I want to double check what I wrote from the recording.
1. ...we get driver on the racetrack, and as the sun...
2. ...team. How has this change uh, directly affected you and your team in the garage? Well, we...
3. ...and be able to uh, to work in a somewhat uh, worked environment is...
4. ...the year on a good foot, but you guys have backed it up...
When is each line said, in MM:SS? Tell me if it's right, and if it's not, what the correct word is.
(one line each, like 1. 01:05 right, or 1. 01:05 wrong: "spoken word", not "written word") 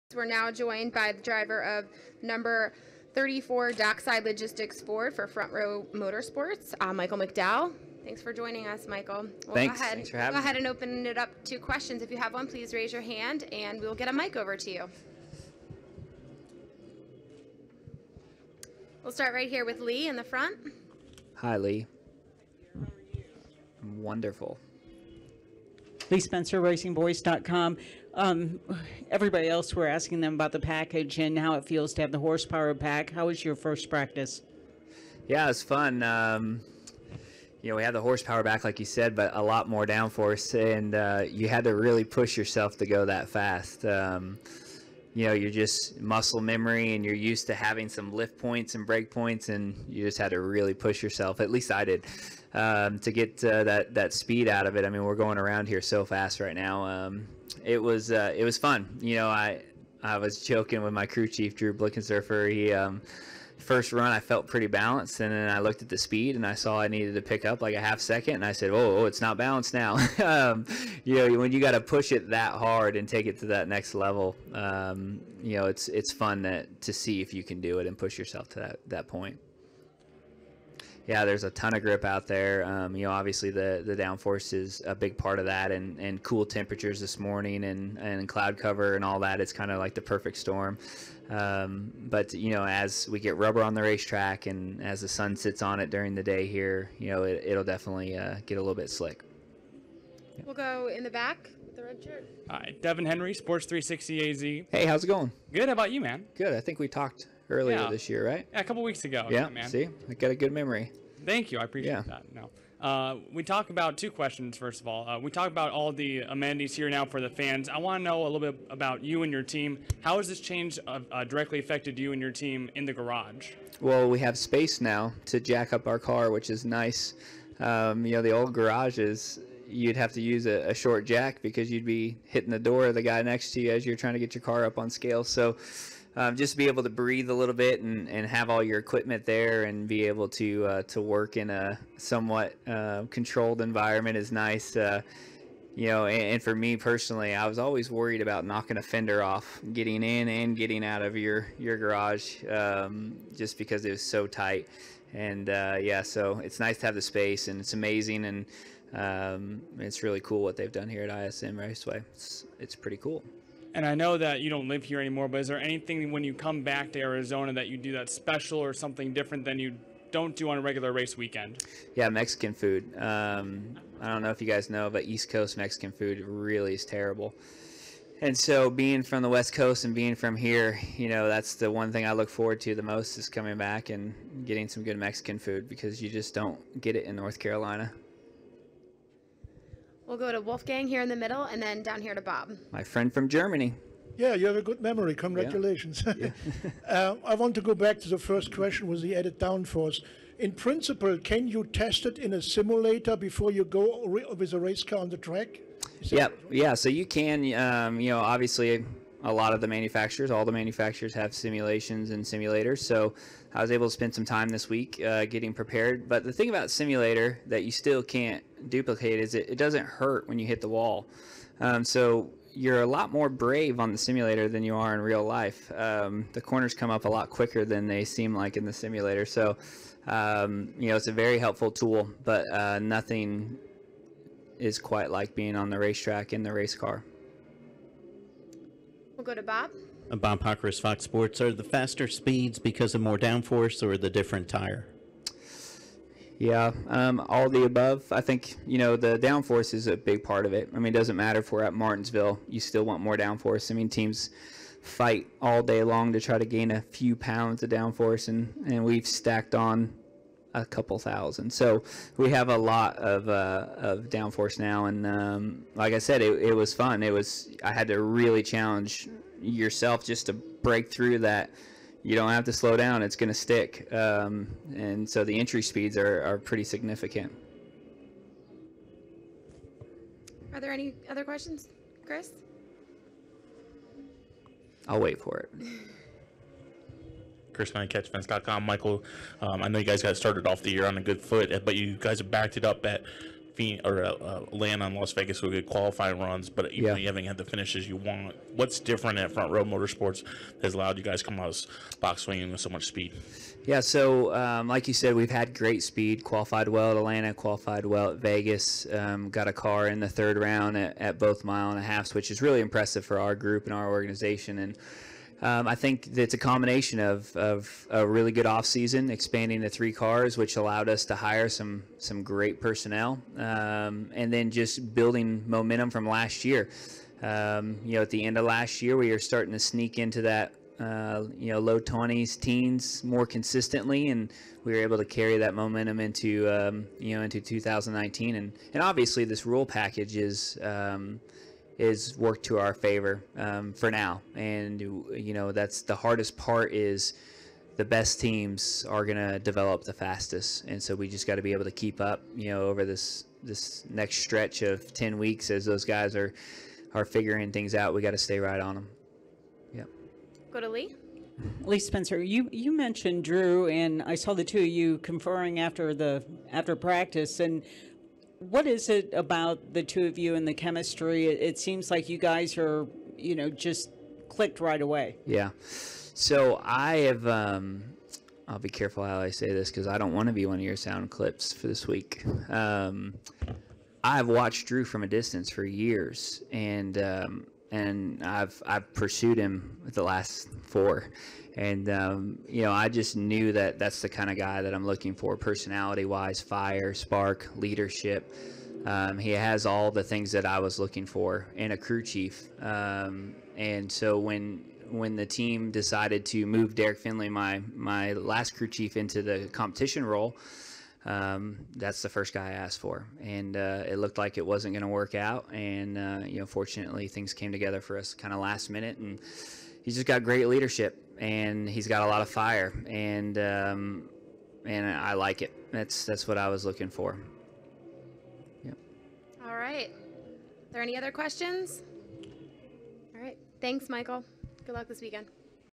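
1. 01:33 wrong: "rubber", not "driver"
2. 01:59 right
3. 02:19 wrong: "controlled", not "worked"
4. 04:50 right.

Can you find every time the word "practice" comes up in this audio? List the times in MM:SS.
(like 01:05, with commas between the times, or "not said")
00:33, 06:06.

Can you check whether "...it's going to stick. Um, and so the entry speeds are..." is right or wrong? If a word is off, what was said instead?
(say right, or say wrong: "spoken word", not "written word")
right.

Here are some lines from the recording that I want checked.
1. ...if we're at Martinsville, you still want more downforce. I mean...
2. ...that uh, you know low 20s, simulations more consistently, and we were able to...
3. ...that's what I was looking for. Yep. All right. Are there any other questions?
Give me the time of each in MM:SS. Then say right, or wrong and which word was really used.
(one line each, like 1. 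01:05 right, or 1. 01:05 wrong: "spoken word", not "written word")
1. 04:11 right
2. 05:30 wrong: "teens", not "simulations"
3. 07:06 right.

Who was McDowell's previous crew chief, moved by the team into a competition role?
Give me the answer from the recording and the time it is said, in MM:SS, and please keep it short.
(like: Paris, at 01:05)
Derrick Finley, at 06:46.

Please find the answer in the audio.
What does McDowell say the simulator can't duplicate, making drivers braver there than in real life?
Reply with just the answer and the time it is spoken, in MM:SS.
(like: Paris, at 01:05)
It doesn't hurt when you hit the wall, at 03:39.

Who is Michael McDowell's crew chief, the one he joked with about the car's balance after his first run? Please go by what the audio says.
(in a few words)
Drew Blickensderfer.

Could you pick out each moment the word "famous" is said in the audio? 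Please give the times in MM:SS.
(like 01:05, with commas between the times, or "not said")
not said.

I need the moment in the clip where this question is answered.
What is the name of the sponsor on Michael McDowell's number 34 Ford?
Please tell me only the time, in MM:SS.
00:03.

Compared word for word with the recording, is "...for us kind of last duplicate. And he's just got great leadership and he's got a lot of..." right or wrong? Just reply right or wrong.
wrong.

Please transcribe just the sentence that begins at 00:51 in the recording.
At least I did um, to get uh, that that speed out of it.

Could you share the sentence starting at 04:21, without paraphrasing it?
So we have a lot of uh, of downforce now, and um, like I said, it, it was fun.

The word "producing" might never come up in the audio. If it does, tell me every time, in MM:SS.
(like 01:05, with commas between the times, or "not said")
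not said.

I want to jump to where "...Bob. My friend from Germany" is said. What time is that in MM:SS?
03:12.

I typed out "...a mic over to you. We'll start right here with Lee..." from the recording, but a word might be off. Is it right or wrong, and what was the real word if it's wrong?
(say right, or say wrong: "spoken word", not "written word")
right.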